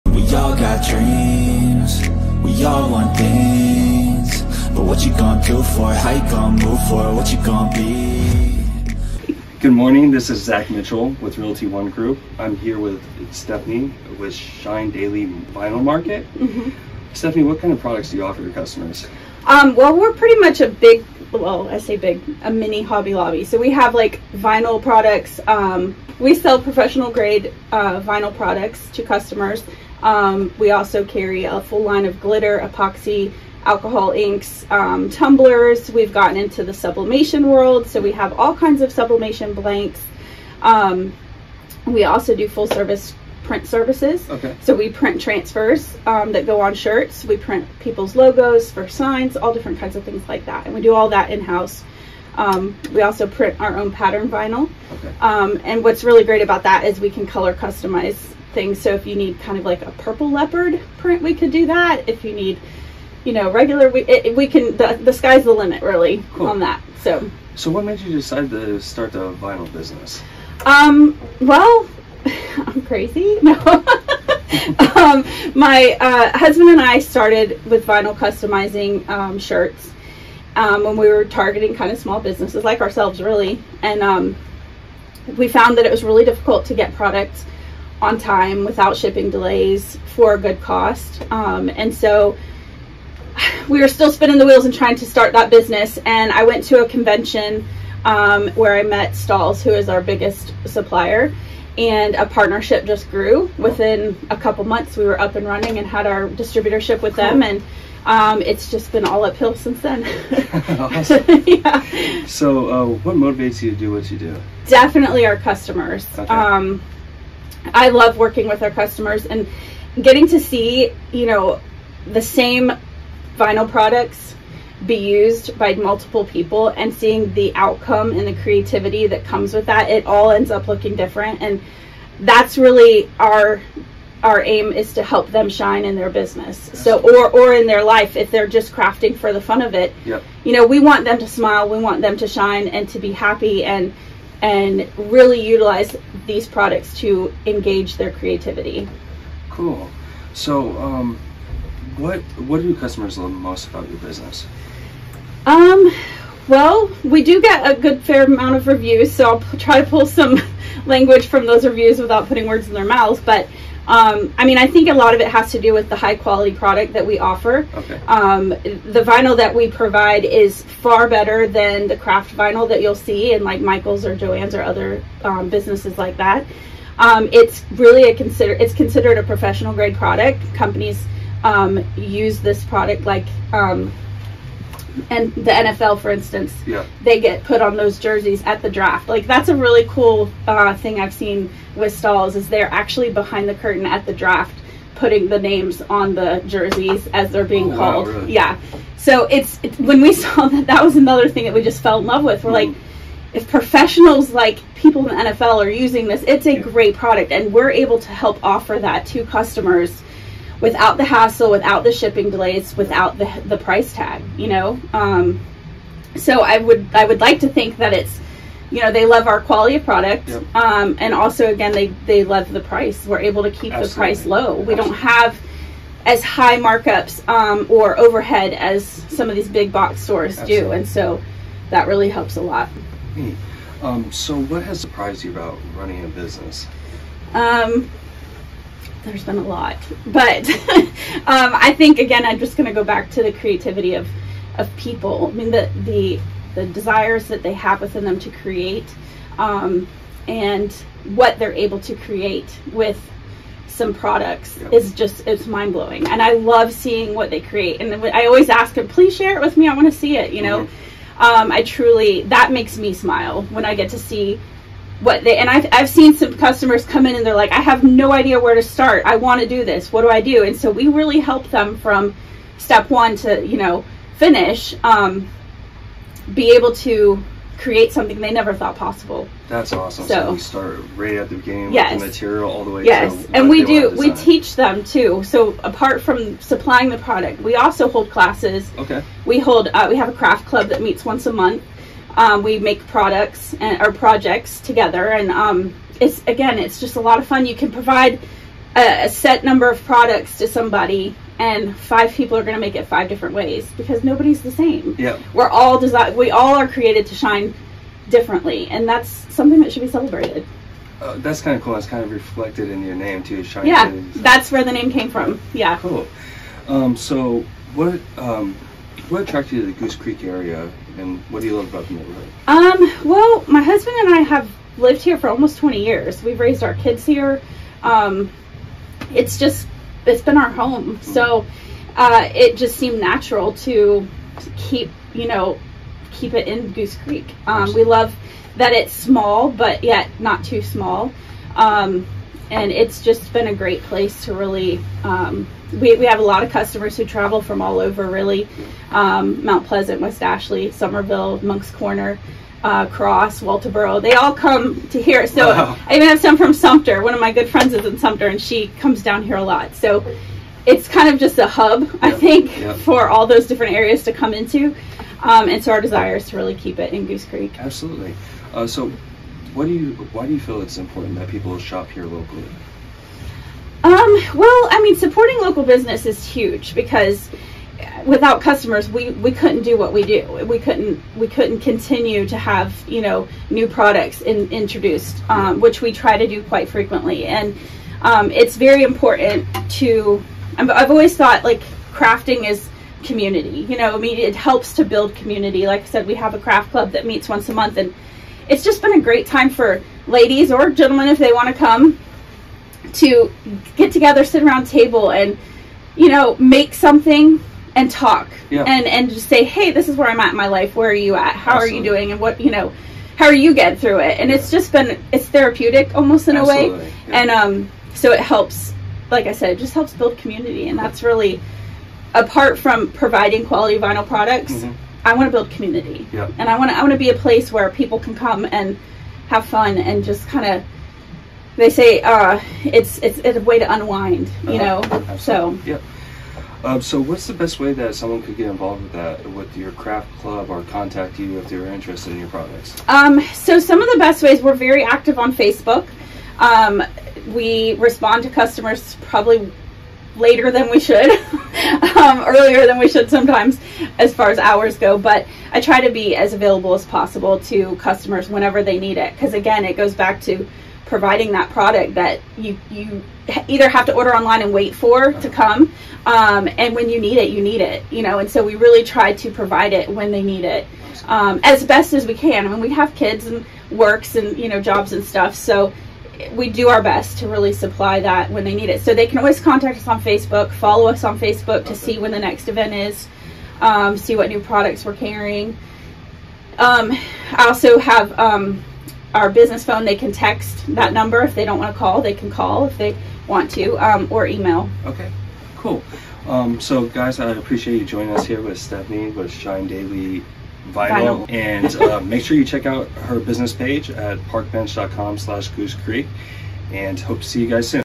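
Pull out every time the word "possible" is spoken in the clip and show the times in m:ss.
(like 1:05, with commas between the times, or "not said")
4:38, 7:36.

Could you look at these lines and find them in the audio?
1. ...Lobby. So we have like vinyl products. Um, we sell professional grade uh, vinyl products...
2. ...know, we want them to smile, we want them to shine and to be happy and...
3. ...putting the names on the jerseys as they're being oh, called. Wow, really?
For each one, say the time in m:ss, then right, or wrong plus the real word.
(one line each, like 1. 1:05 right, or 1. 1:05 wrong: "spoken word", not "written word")
1. 0:23 right
2. 2:20 right
3. 3:14 right.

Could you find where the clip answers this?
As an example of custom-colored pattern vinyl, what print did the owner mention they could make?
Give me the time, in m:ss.
0:59.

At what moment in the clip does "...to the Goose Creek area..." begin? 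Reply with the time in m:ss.
5:19.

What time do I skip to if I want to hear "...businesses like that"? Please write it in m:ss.
2:55.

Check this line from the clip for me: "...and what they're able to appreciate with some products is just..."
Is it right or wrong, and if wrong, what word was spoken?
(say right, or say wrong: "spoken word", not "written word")
wrong: "create", not "appreciate".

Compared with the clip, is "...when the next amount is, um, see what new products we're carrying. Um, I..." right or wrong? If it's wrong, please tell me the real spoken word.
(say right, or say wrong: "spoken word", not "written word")
wrong: "event", not "amount".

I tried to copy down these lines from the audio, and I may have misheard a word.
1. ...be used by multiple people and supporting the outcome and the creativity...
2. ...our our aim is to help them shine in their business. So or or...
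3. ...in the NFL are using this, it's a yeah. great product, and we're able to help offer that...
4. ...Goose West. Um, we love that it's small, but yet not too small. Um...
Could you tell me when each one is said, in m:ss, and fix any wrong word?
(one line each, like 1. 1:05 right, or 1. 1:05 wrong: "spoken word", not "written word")
1. 2:04 wrong: "seeing", not "supporting"
2. 2:13 right
3. 3:25 right
4. 5:36 wrong: "Creek", not "West".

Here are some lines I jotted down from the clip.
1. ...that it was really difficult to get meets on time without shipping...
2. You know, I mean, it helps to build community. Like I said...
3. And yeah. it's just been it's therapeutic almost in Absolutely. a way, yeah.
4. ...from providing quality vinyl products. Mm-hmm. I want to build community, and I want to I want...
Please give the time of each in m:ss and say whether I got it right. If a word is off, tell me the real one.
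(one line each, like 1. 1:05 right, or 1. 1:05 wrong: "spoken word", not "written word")
1. 1:25 wrong: "products", not "meets"
2. 6:33 right
3. 6:54 right
4. 7:02 right.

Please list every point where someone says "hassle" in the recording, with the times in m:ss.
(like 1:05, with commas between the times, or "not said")
3:31.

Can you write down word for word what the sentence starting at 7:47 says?
You know, and so we really try to provide it when they need it um, as best as we can.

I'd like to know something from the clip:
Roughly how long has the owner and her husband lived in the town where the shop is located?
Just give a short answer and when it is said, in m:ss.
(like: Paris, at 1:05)
Almost 20 years, at 5:25.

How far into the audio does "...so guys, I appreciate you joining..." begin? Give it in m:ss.
8:16.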